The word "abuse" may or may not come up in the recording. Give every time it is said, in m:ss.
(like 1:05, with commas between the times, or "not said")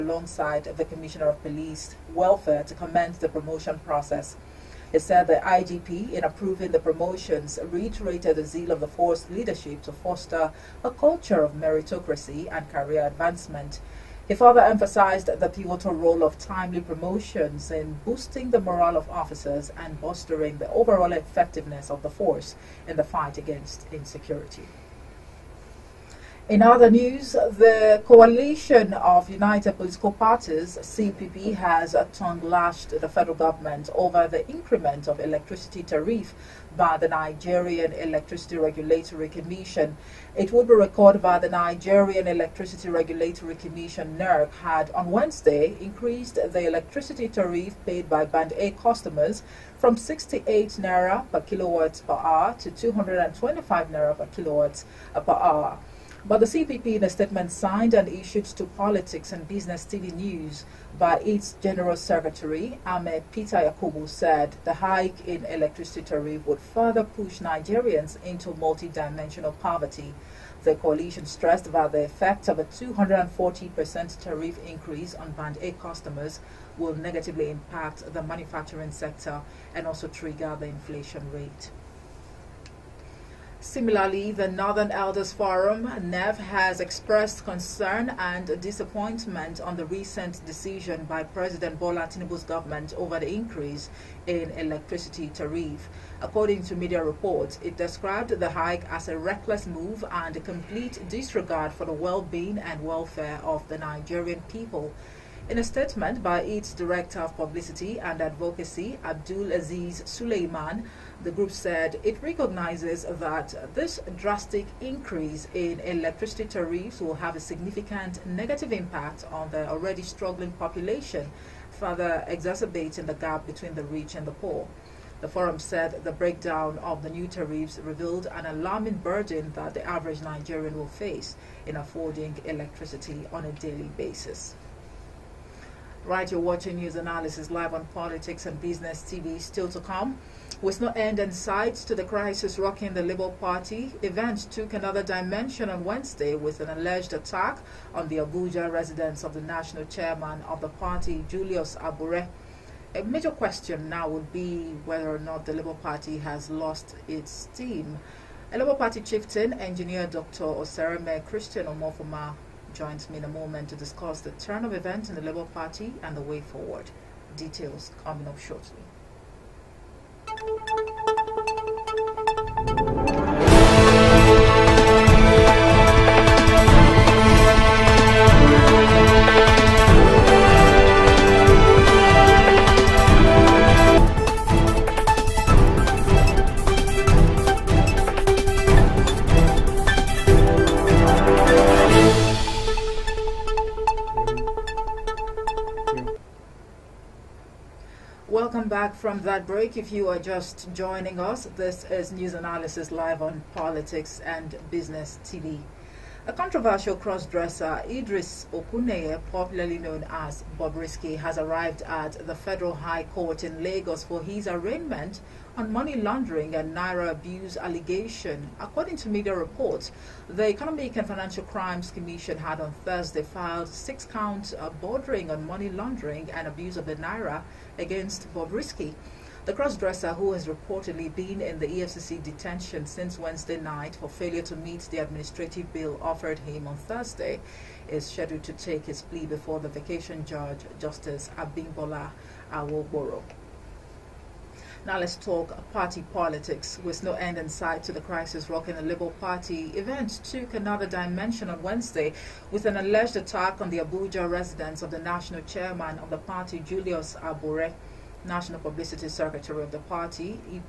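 3:37, 3:46.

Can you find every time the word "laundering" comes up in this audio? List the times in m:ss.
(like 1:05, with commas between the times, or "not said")
3:35, 3:45.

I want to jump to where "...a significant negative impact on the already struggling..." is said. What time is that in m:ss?
1:57.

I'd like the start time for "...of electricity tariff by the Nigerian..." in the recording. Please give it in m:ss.
0:35.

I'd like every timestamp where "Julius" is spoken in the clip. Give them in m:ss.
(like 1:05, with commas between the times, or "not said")
2:31, 4:16.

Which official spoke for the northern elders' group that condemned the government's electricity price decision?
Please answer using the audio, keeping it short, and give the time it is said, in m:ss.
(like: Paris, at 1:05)
Abdul Aziz Suleiman, at 1:49.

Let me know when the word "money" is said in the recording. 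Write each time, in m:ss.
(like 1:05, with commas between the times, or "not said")
3:35, 3:45.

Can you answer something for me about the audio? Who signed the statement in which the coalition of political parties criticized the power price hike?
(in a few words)
Ahmed Peter Yakubu.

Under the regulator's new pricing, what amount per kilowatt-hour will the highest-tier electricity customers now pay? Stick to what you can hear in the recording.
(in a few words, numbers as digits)
225 naira.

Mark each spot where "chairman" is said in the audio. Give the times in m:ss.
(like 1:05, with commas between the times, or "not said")
2:29, 4:15.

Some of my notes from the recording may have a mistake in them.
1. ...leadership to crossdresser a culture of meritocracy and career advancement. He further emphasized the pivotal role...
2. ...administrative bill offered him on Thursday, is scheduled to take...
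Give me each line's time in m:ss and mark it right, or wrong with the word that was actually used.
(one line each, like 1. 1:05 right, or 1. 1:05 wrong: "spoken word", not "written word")
1. 0:09 wrong: "foster", not "crossdresser"
2. 3:54 right.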